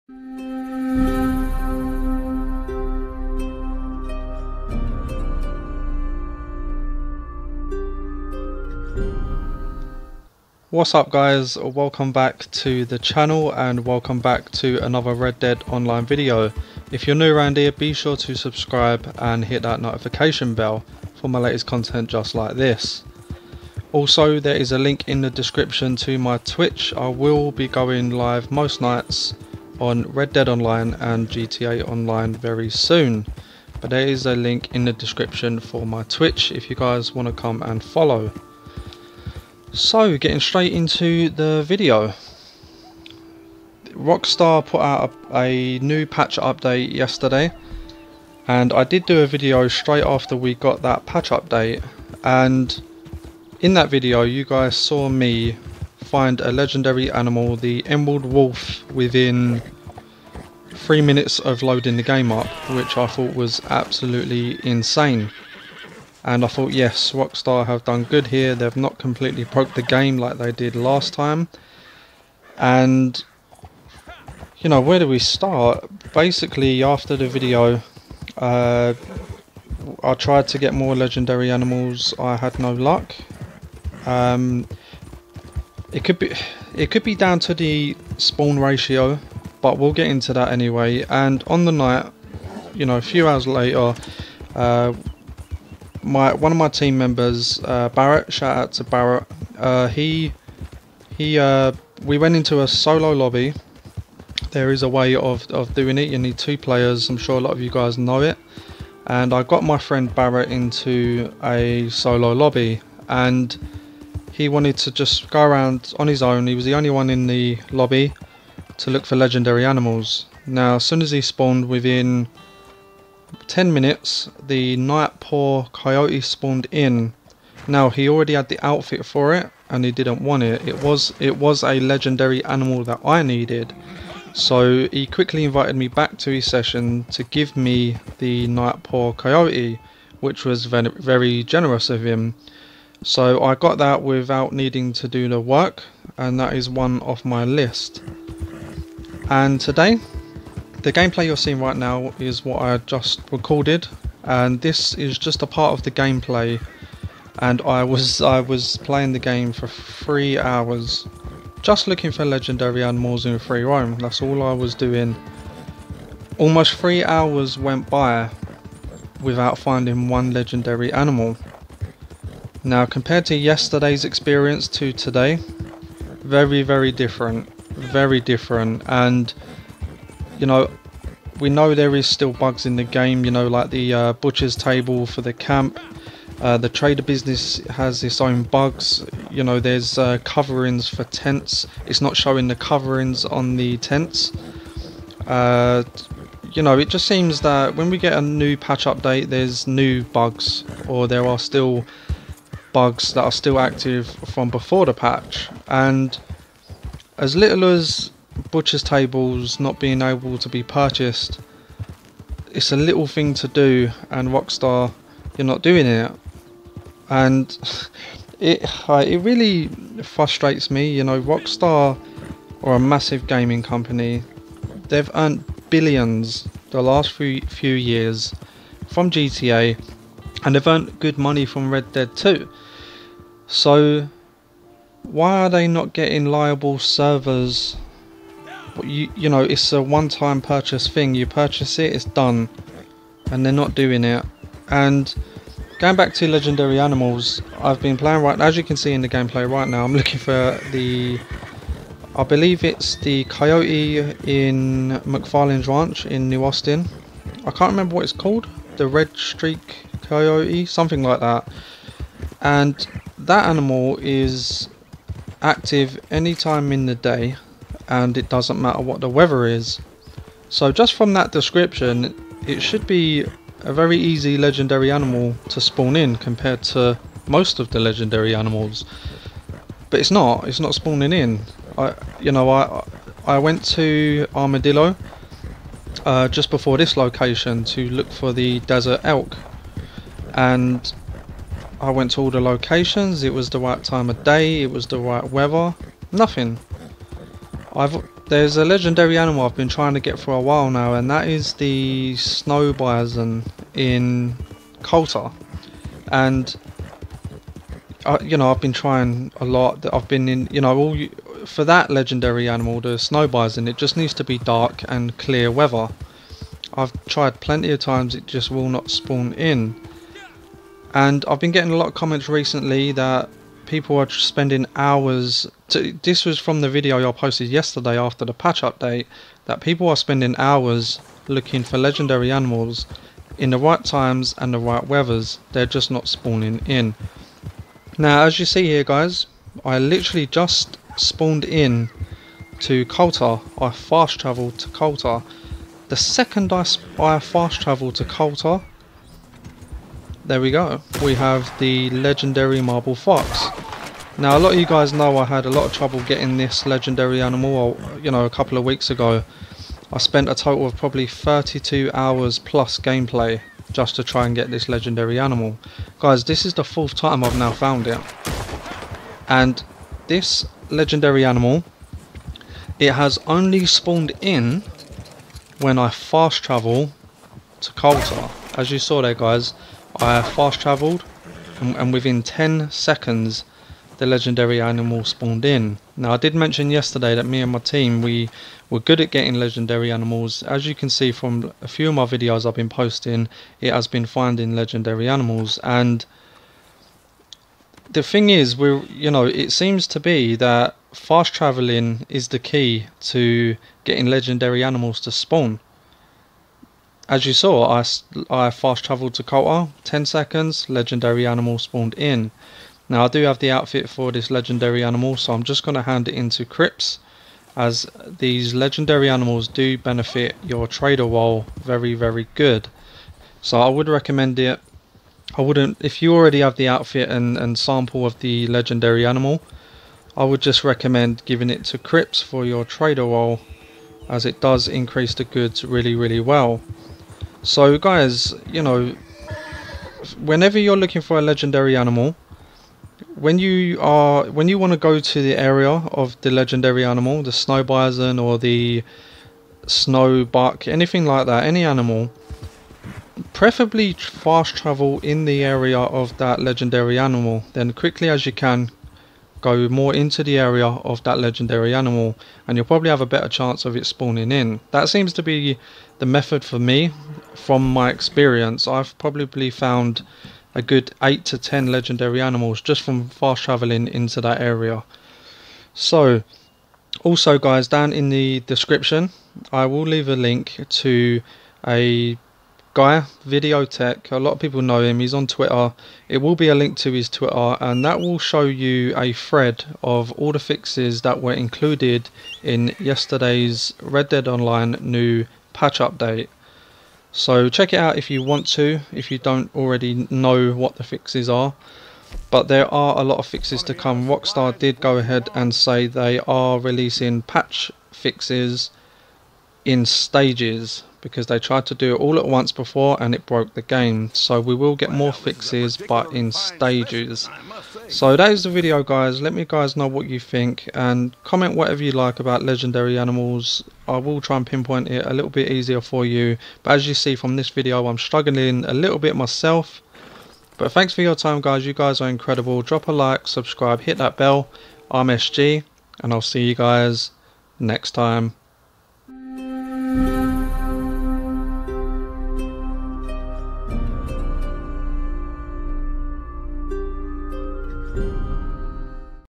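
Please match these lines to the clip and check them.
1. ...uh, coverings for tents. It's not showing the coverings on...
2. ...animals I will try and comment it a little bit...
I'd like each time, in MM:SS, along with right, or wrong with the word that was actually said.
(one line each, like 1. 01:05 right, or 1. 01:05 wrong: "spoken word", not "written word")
1. 03:09 right
2. 08:42 wrong: "pinpoint", not "comment".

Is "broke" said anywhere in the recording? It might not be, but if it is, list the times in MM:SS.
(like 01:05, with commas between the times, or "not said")
01:09, 08:33.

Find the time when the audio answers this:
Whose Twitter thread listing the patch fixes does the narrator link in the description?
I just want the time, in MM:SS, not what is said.
08:03.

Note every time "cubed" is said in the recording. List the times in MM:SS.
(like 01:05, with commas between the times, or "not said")
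not said.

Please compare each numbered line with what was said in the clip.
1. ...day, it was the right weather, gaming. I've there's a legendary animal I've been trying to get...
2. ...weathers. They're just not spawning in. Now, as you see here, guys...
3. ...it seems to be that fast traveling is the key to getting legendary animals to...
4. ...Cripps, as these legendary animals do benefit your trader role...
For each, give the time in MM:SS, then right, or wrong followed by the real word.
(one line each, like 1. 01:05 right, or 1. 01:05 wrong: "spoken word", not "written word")
1. 04:54 wrong: "nothing", not "gaming"
2. 05:34 right
3. 06:39 right
4. 06:56 right.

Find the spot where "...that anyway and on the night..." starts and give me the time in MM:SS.
01:30.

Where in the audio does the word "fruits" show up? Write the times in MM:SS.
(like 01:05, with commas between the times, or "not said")
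not said.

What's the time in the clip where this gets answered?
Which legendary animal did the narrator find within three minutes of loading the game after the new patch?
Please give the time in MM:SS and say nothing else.
00:57.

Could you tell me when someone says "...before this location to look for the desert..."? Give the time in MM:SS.
04:46.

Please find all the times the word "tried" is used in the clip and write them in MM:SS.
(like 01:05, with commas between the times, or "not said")
01:20, 05:17, 08:31.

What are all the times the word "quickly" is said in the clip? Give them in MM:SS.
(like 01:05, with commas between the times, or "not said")
02:15, 07:37.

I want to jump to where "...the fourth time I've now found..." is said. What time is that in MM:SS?
06:06.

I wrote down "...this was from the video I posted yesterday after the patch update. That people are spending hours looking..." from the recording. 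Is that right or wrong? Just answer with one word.
right.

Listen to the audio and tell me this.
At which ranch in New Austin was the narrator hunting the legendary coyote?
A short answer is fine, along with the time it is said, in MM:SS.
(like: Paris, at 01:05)
McFarlane's ranch, at 04:15.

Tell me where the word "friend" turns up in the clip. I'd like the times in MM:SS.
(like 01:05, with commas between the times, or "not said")
01:49.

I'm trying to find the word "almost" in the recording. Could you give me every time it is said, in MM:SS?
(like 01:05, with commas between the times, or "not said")
02:46.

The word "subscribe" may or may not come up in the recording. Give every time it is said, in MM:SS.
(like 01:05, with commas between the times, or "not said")
00:18, 08:53.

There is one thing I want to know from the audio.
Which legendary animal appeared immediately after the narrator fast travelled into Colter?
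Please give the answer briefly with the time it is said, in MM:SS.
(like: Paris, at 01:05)
marble fox, at 05:52.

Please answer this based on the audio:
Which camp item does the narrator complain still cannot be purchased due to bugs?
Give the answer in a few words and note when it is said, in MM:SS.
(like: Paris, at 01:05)
butcher's table, at 03:04.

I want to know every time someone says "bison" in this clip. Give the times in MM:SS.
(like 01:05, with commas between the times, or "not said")
05:02, 05:13, 07:27.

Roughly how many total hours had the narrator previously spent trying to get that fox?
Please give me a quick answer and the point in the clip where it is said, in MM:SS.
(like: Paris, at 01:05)
32, at 06:01.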